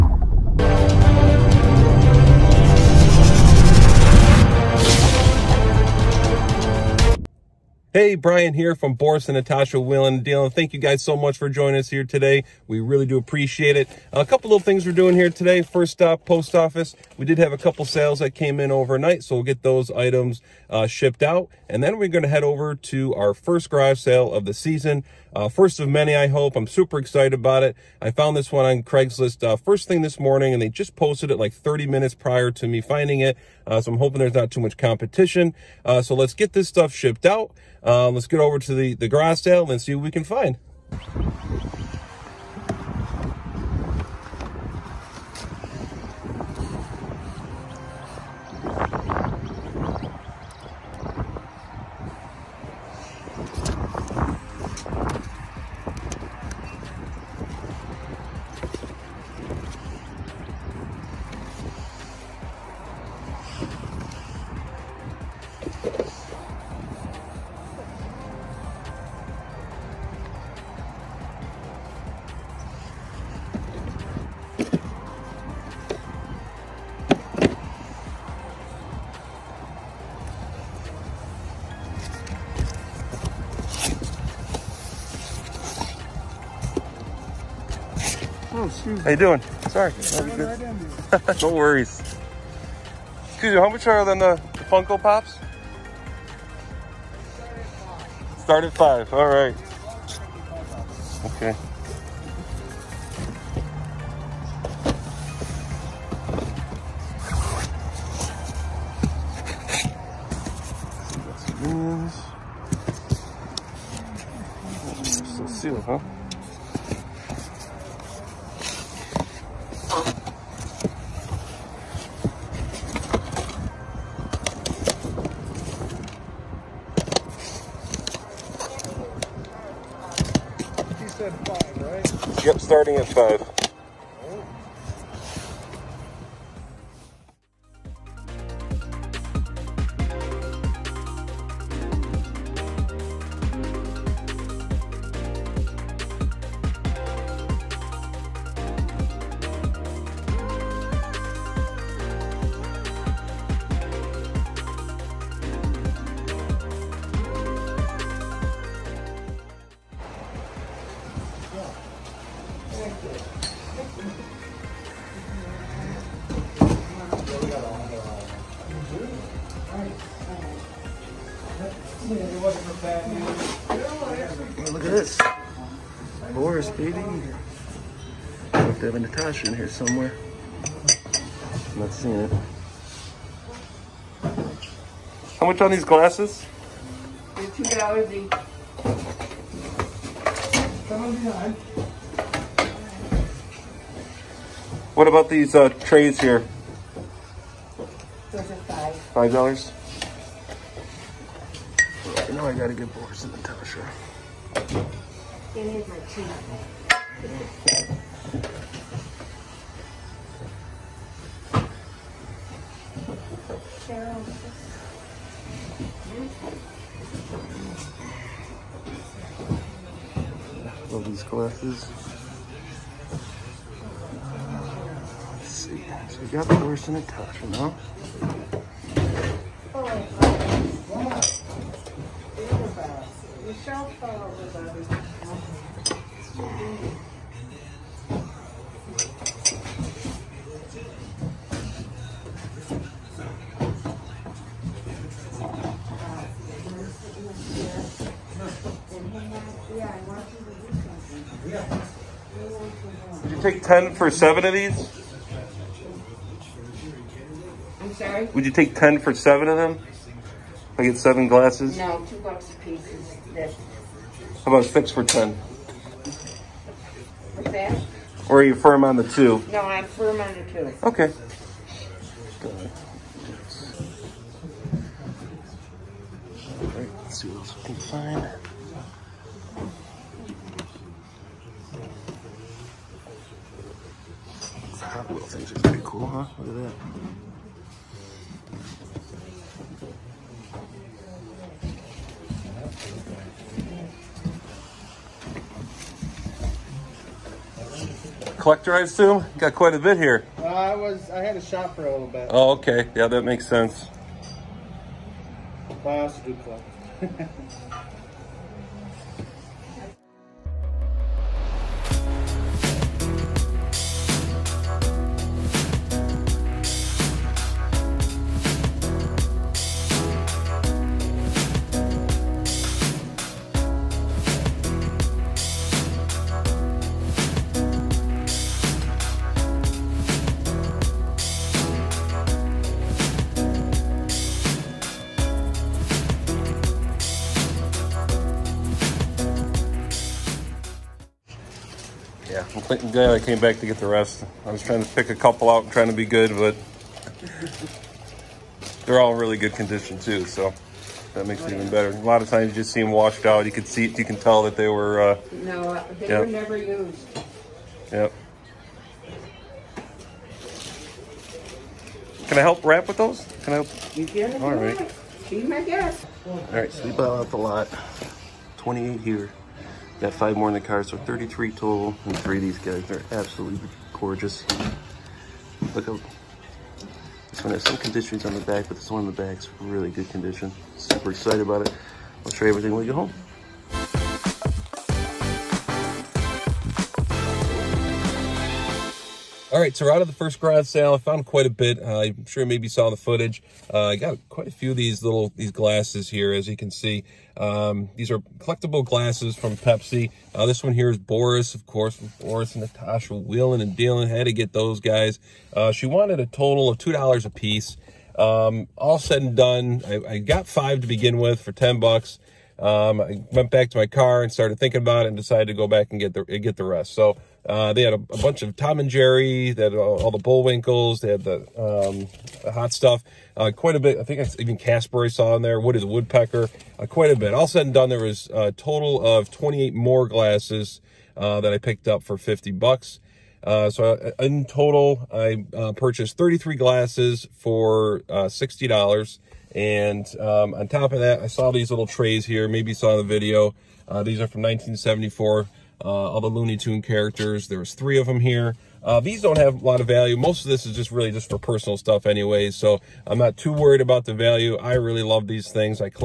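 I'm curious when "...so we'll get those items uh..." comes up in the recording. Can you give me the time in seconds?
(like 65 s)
19 s.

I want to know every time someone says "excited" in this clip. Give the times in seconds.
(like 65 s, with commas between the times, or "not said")
26 s, 381 s.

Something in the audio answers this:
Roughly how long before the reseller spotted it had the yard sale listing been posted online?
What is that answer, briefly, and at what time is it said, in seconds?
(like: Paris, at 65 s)
30 minutes, at 31 s.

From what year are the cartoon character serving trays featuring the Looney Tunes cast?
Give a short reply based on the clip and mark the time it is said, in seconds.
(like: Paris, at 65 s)
1974, at 444 s.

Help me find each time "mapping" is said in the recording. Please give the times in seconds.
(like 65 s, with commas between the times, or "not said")
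not said.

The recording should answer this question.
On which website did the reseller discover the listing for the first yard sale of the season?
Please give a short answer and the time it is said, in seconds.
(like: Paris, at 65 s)
Craigslist, at 28 s.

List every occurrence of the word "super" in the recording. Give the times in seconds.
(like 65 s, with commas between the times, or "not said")
26 s, 380 s.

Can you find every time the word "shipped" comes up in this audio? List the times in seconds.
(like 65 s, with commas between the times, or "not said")
20 s, 36 s.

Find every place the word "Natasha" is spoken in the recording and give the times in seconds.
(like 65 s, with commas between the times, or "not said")
9 s, 178 s, 203 s, 226 s, 402 s.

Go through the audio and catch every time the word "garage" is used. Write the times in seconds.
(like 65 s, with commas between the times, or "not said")
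23 s, 390 s.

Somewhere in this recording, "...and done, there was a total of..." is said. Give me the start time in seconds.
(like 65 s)
427 s.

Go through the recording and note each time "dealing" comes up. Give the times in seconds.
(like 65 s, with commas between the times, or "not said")
10 s, 403 s.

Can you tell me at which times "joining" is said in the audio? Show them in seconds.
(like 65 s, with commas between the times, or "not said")
11 s.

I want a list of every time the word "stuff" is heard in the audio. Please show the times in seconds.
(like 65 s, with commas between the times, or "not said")
36 s, 422 s, 451 s.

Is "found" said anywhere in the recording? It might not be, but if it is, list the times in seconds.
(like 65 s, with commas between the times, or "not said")
28 s, 390 s.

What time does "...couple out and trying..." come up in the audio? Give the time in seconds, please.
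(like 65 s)
345 s.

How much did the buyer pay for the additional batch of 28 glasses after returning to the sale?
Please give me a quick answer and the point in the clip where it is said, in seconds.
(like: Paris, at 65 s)
$50, at 432 s.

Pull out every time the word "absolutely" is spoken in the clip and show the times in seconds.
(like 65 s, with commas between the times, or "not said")
373 s.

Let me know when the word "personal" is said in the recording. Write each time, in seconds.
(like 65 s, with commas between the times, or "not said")
451 s.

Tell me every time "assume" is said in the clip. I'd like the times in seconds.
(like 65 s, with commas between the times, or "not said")
298 s.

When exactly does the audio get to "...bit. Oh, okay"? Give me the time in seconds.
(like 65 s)
302 s.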